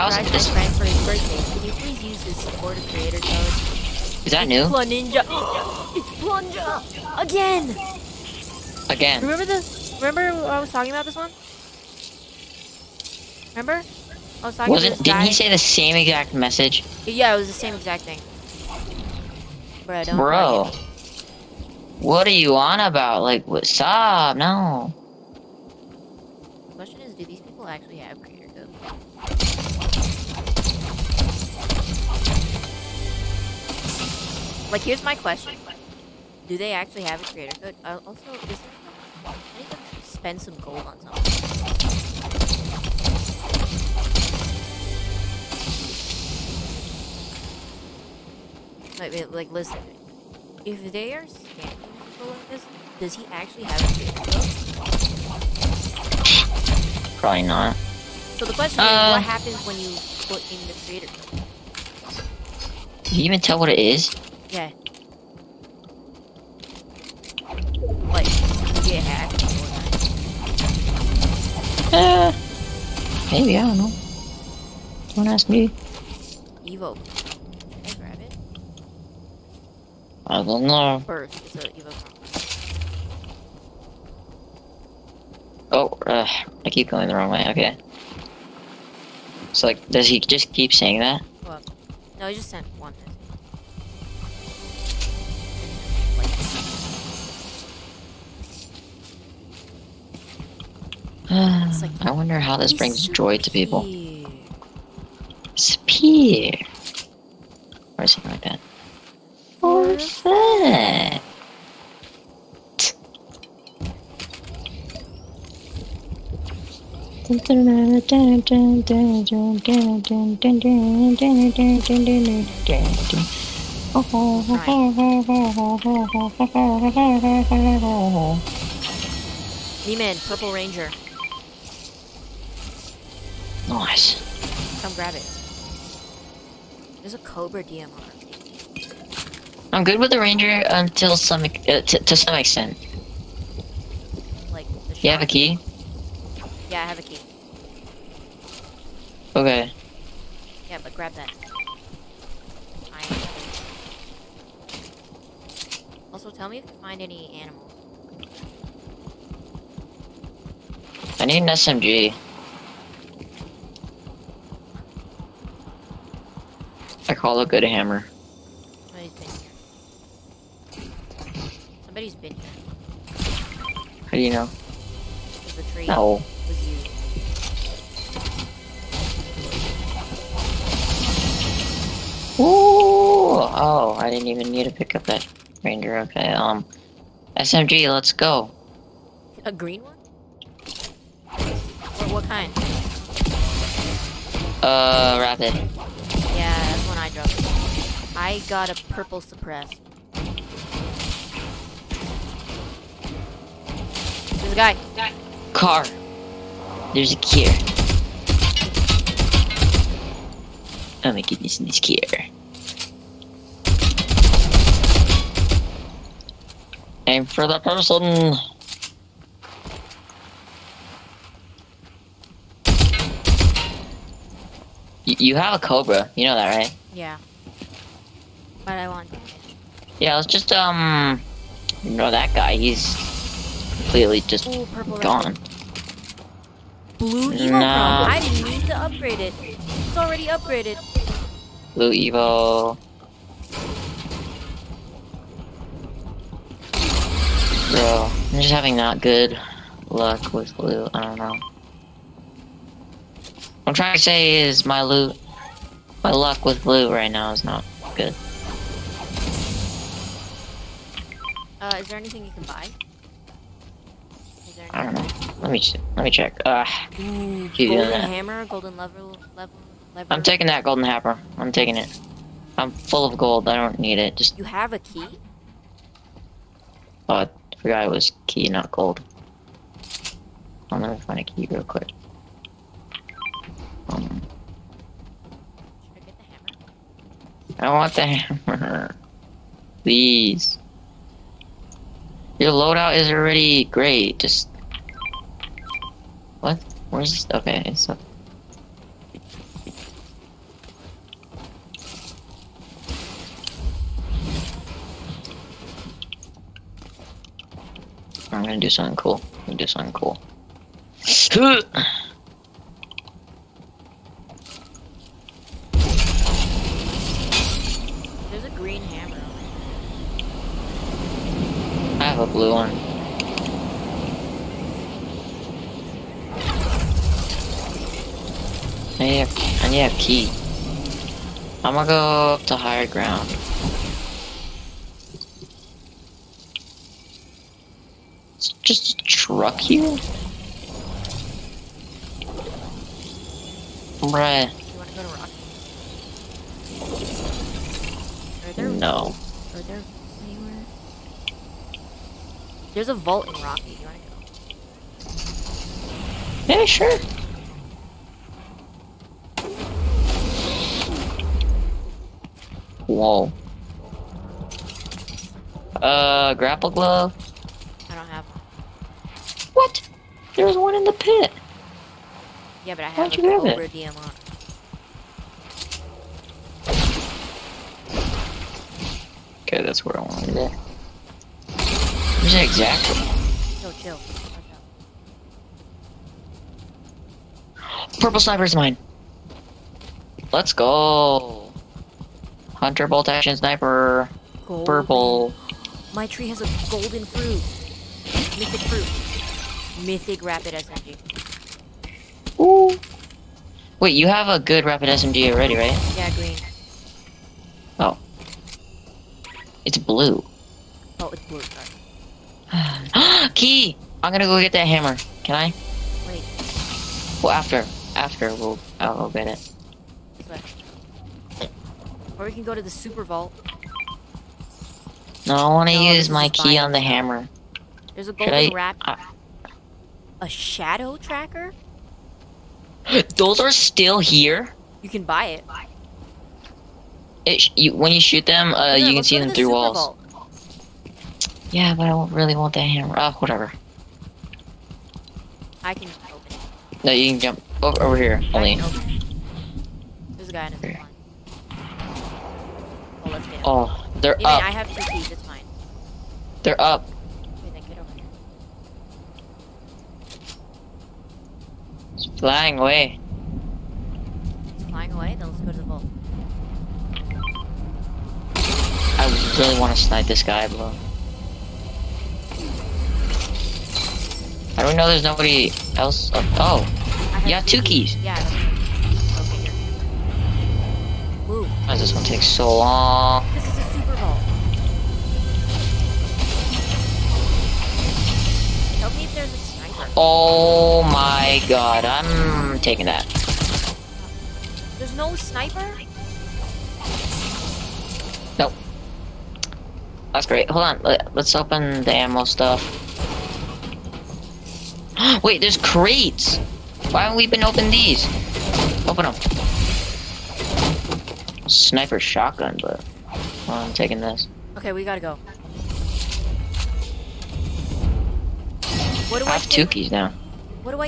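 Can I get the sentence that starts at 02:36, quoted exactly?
Also, tell me if you find any animals.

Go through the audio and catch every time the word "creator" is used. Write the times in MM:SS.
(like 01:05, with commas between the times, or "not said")
00:02, 00:28, 00:37, 00:53, 01:00.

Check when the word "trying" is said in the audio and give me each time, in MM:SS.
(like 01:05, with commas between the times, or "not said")
04:13.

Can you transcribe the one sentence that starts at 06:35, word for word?
My tree has a golden fruit.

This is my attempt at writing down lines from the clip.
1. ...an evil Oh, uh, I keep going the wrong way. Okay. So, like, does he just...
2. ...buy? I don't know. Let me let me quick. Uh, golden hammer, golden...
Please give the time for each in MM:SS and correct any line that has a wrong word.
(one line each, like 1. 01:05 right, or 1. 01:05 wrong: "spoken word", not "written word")
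1. 01:21 right
2. 04:22 wrong: "check", not "quick".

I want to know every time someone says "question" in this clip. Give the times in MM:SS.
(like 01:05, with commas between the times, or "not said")
00:26, 00:35, 00:58.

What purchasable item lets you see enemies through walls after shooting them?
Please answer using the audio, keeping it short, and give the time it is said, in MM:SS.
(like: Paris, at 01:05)
Shadow tracker, at 07:10.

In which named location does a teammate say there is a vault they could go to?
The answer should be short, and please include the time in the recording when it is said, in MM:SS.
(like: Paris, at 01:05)
Rocky, at 05:52.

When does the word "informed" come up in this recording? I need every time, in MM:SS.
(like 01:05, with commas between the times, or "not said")
not said.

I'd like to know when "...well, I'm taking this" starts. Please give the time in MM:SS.
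08:33.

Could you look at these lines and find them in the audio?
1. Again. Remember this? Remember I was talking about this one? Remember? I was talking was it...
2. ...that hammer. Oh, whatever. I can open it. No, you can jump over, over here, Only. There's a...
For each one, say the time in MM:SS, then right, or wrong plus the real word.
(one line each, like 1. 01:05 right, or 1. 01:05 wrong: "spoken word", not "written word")
1. 00:08 right
2. 07:22 right.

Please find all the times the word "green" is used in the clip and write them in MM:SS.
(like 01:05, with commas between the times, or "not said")
03:09, 05:18, 06:46.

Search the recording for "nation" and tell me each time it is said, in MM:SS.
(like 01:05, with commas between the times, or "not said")
not said.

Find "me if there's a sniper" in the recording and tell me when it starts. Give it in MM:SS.
08:08.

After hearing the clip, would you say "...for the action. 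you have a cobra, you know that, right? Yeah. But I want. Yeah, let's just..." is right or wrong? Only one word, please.
wrong.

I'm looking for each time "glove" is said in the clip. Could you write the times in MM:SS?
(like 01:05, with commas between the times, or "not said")
06:06.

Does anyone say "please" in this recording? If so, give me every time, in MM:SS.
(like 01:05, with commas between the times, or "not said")
00:01, 04:49.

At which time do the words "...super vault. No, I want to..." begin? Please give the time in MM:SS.
07:02.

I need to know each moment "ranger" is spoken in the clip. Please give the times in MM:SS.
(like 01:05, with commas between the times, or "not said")
02:10, 02:20, 03:05.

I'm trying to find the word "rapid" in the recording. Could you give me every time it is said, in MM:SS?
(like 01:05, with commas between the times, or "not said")
03:15, 06:40, 06:44.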